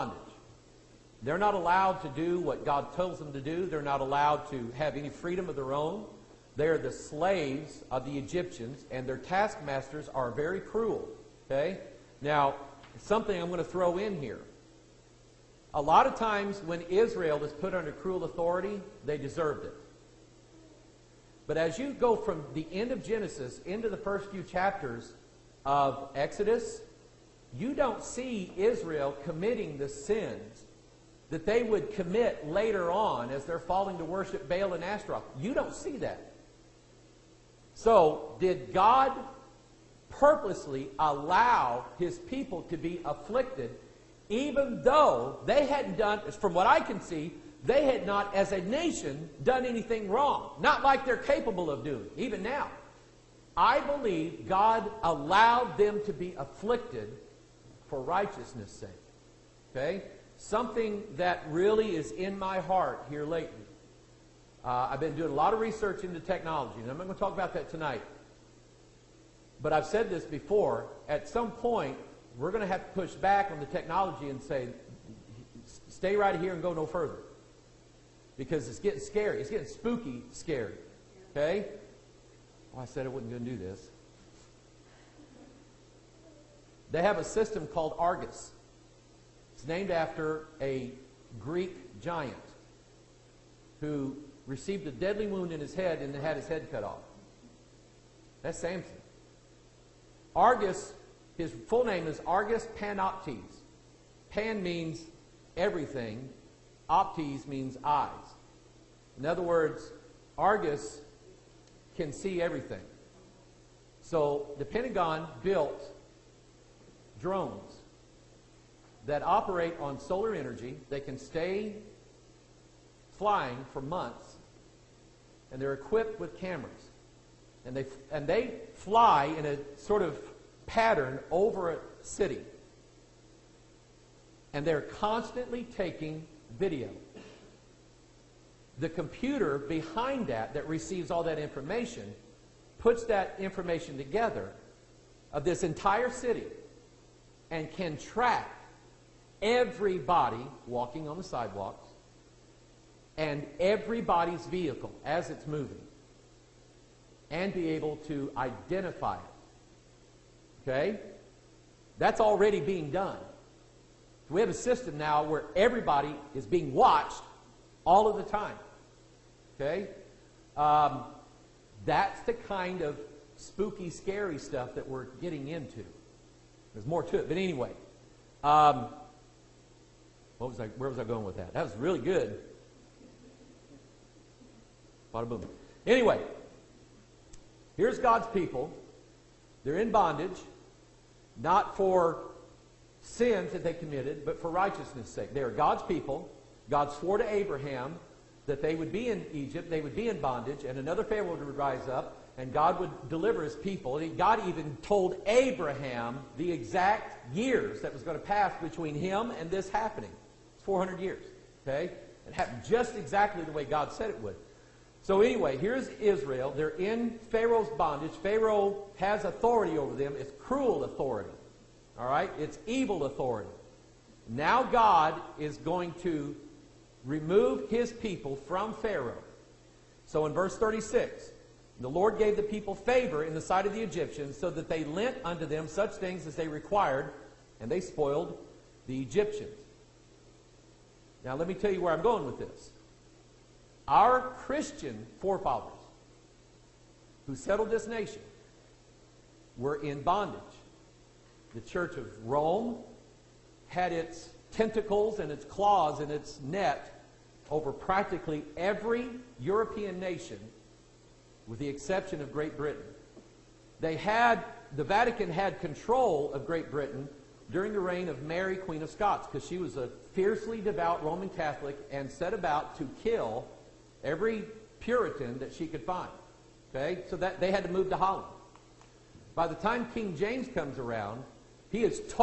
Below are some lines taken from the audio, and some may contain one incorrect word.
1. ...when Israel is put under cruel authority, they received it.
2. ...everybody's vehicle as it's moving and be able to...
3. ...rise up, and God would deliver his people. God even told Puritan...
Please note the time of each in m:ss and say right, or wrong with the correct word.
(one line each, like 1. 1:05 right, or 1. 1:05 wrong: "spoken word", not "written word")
1. 0:16 wrong: "deserved", not "received"
2. 2:33 right
3. 3:21 wrong: "Abraham", not "Puritan".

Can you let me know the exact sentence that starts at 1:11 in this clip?
At some point, we're going to have to push back on the technology and say, stay right here and go no further.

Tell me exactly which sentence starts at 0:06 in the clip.
They're the slaves of the Egyptians, and their taskmasters are very cruel.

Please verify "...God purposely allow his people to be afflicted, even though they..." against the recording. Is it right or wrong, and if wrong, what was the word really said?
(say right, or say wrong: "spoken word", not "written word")
right.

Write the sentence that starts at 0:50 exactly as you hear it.
Not like they're capable of doing, even now.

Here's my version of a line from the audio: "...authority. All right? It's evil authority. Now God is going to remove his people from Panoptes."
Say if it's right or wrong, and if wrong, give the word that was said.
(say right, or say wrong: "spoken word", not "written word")
wrong: "Pharaoh", not "Panoptes".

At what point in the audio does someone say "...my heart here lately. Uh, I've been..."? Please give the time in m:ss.
1:02.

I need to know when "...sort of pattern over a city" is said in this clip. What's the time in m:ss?
2:09.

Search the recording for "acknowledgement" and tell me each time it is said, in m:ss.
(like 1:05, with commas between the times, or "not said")
not said.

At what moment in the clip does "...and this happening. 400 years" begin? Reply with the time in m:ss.
3:29.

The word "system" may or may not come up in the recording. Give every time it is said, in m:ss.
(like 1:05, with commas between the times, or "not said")
1:27, 2:44.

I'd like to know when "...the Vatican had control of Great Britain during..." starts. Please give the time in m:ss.
4:24.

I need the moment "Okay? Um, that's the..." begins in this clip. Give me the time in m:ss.
2:49.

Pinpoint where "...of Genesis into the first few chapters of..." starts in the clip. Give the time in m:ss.
0:22.